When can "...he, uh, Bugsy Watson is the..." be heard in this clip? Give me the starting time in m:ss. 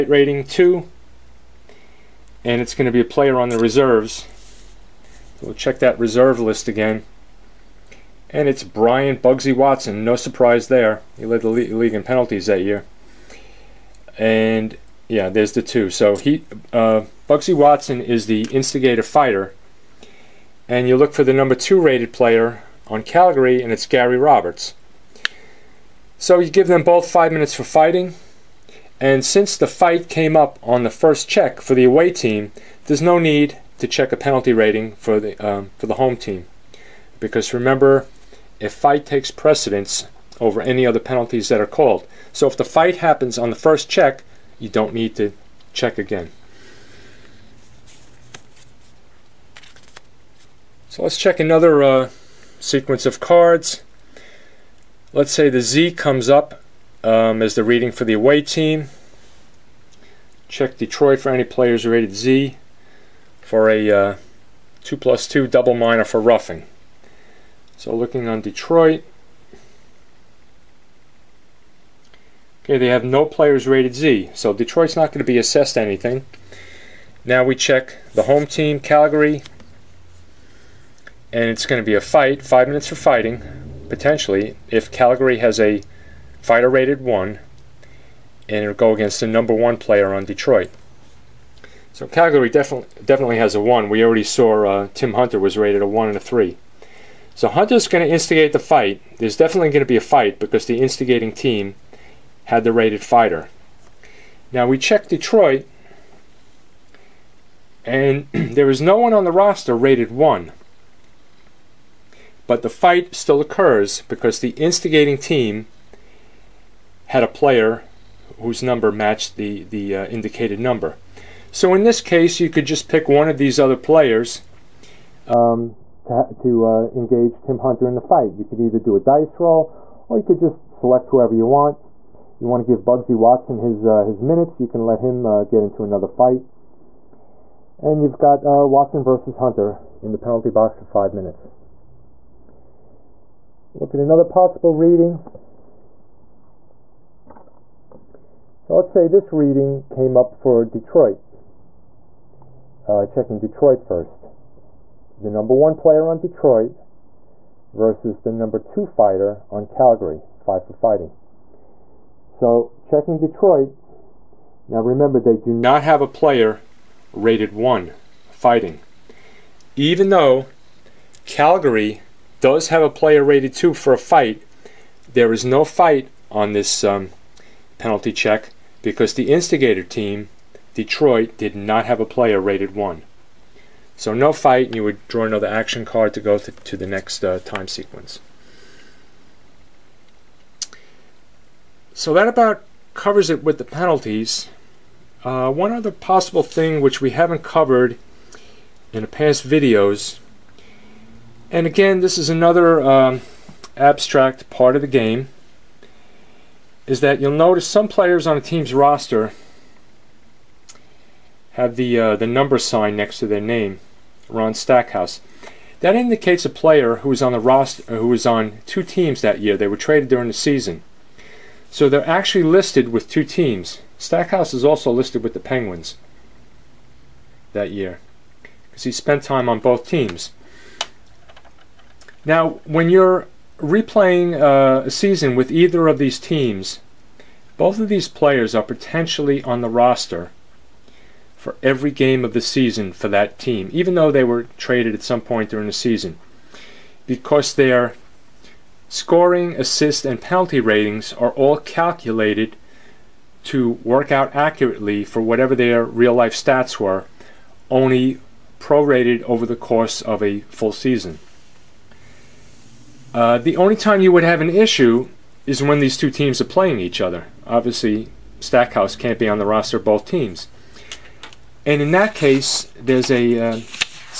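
0:16.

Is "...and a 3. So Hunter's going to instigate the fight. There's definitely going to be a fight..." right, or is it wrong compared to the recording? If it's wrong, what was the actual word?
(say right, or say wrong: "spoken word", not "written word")
right.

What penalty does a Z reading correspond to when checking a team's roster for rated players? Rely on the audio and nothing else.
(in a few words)
2 plus 2 double minor for roughing.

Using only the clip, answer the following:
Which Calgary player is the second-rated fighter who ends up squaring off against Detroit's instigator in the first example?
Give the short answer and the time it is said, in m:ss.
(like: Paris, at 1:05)
Gary Roberts, at 0:23.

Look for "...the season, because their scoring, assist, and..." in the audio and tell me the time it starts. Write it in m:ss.
4:05.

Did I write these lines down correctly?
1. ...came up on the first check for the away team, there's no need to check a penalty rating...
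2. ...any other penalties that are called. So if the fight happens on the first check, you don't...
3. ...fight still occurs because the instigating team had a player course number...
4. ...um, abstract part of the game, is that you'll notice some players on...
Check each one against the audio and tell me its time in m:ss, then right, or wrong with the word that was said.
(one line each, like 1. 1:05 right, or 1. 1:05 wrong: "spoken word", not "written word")
1. 0:30 right
2. 0:40 right
3. 1:52 wrong: "whose", not "course"
4. 3:22 right.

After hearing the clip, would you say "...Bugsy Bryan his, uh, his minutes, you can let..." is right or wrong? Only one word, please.
wrong.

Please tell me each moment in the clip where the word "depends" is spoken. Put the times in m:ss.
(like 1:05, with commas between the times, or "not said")
not said.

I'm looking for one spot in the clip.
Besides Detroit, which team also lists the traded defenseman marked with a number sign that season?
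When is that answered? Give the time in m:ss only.
3:45.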